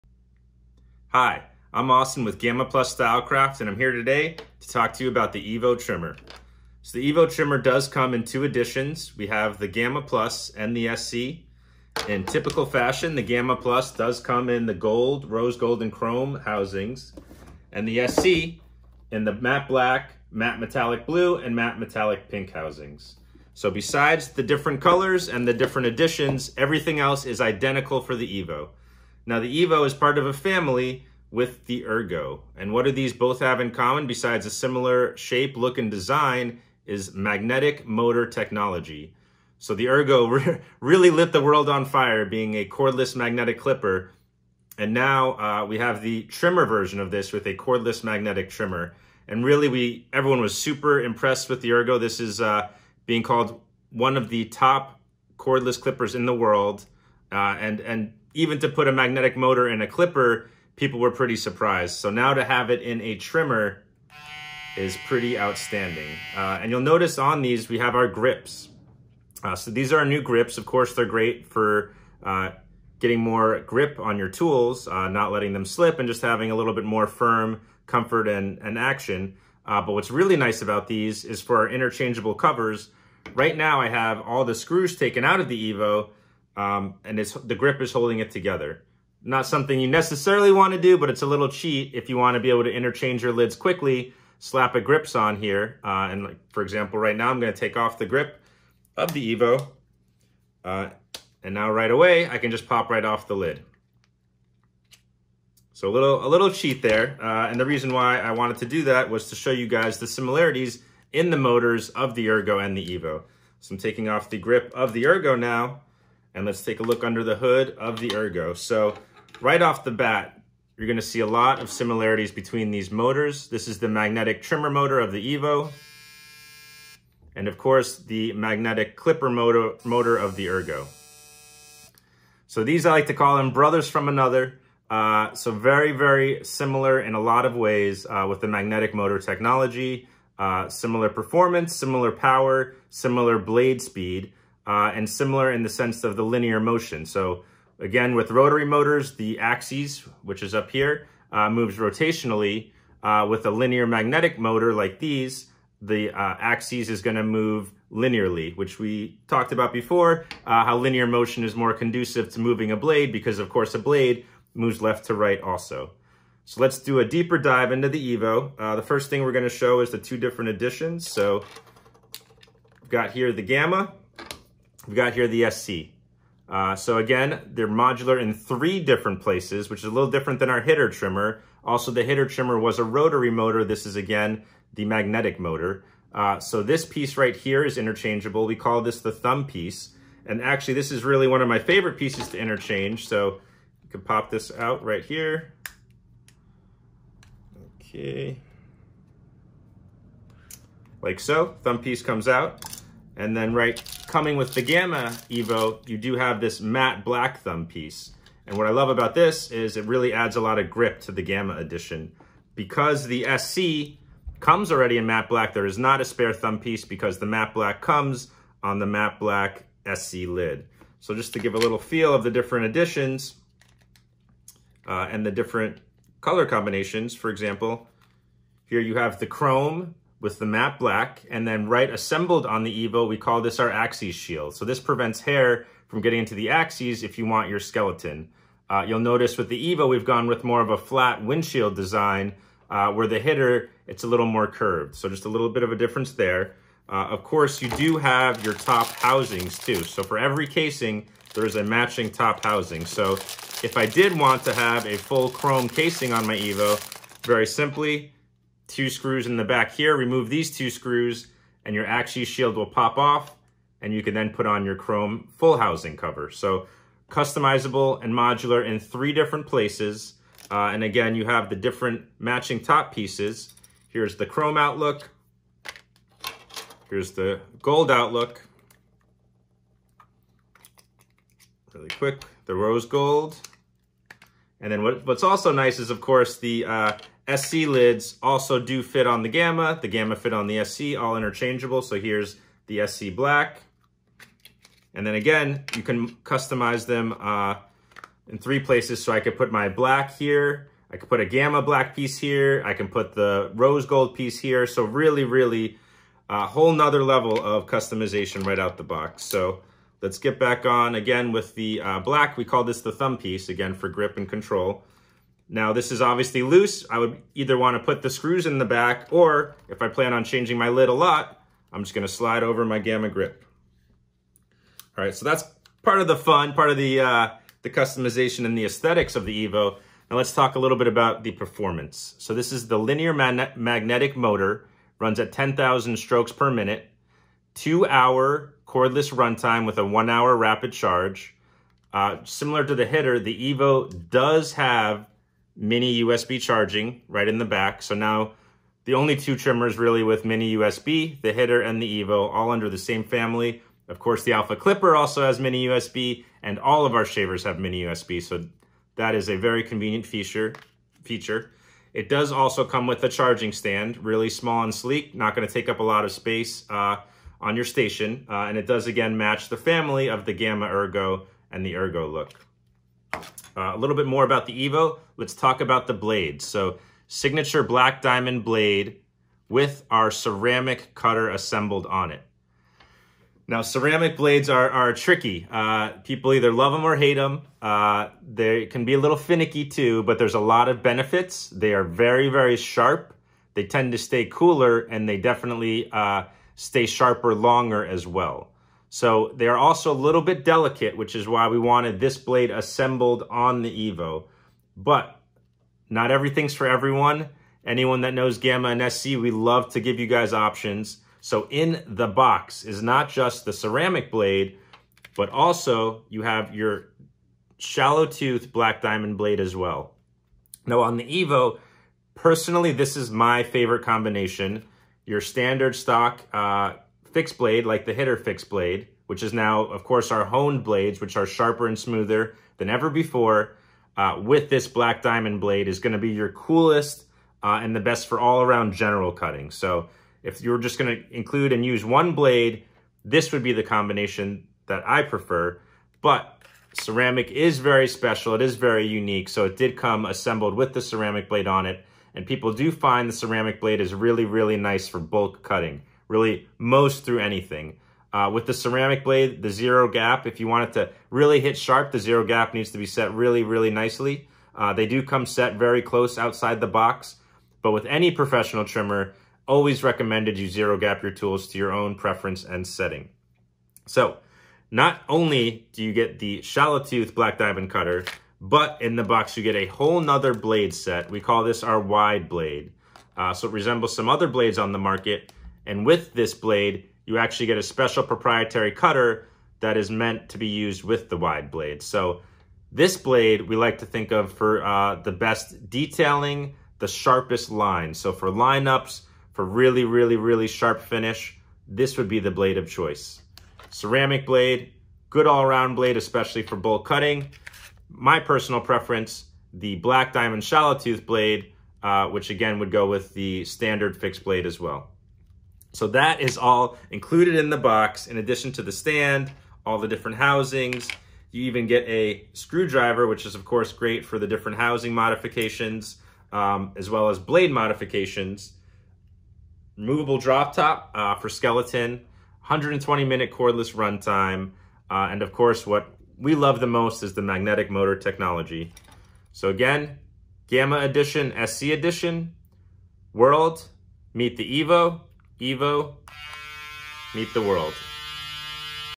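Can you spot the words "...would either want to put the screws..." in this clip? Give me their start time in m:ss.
5:16.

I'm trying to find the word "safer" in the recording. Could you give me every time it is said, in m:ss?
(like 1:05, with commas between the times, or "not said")
not said.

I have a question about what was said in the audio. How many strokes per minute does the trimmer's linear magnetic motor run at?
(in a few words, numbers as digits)
10,000.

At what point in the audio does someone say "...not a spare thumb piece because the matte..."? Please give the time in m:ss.
3:35.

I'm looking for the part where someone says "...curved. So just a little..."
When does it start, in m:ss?
4:04.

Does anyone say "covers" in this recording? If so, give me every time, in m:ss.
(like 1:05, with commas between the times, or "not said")
1:22, 4:25.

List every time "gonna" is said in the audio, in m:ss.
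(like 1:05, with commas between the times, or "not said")
2:00, 2:37, 2:49, 6:05.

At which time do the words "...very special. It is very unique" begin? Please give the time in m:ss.
7:27.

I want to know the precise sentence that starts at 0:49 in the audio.
And really we everyone was super impressed with the Ergo.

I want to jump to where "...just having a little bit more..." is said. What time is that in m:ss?
1:16.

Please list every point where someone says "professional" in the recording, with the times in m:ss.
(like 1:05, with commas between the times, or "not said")
7:48.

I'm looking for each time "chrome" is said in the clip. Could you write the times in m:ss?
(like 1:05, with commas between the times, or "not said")
0:15, 3:49, 4:15, 4:24, 4:34.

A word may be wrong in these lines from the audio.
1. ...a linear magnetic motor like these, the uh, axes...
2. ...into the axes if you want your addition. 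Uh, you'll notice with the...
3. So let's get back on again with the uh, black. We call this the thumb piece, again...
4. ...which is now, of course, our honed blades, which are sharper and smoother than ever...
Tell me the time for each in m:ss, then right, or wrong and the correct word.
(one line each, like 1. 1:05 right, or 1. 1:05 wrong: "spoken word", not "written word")
1. 2:33 right
2. 3:56 wrong: "skeleton", not "addition"
3. 5:09 right
4. 7:09 right.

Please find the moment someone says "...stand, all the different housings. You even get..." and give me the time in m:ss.
8:38.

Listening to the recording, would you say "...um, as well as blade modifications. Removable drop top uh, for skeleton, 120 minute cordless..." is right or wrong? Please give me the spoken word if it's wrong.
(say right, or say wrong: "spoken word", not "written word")
right.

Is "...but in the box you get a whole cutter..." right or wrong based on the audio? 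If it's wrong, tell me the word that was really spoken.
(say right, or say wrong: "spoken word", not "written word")
wrong: "nother", not "cutter".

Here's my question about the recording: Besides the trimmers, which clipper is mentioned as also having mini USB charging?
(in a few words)
Alpha Clipper.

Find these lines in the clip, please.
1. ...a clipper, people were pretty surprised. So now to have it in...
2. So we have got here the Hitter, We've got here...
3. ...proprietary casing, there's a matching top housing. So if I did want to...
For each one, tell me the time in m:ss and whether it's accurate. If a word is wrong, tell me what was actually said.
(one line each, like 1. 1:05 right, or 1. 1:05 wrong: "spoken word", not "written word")
1. 0:59 right
2. 2:51 wrong: "Gamma", not "Hitter"
3. 4:10 wrong: "every", not "proprietary".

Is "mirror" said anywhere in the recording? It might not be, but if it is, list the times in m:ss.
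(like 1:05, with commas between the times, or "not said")
not said.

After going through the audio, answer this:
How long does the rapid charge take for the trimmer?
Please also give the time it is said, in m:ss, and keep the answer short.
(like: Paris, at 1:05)
1 hour, at 5:39.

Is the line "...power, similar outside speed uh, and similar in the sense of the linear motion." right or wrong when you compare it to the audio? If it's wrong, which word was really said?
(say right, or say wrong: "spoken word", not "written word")
wrong: "blade", not "outside".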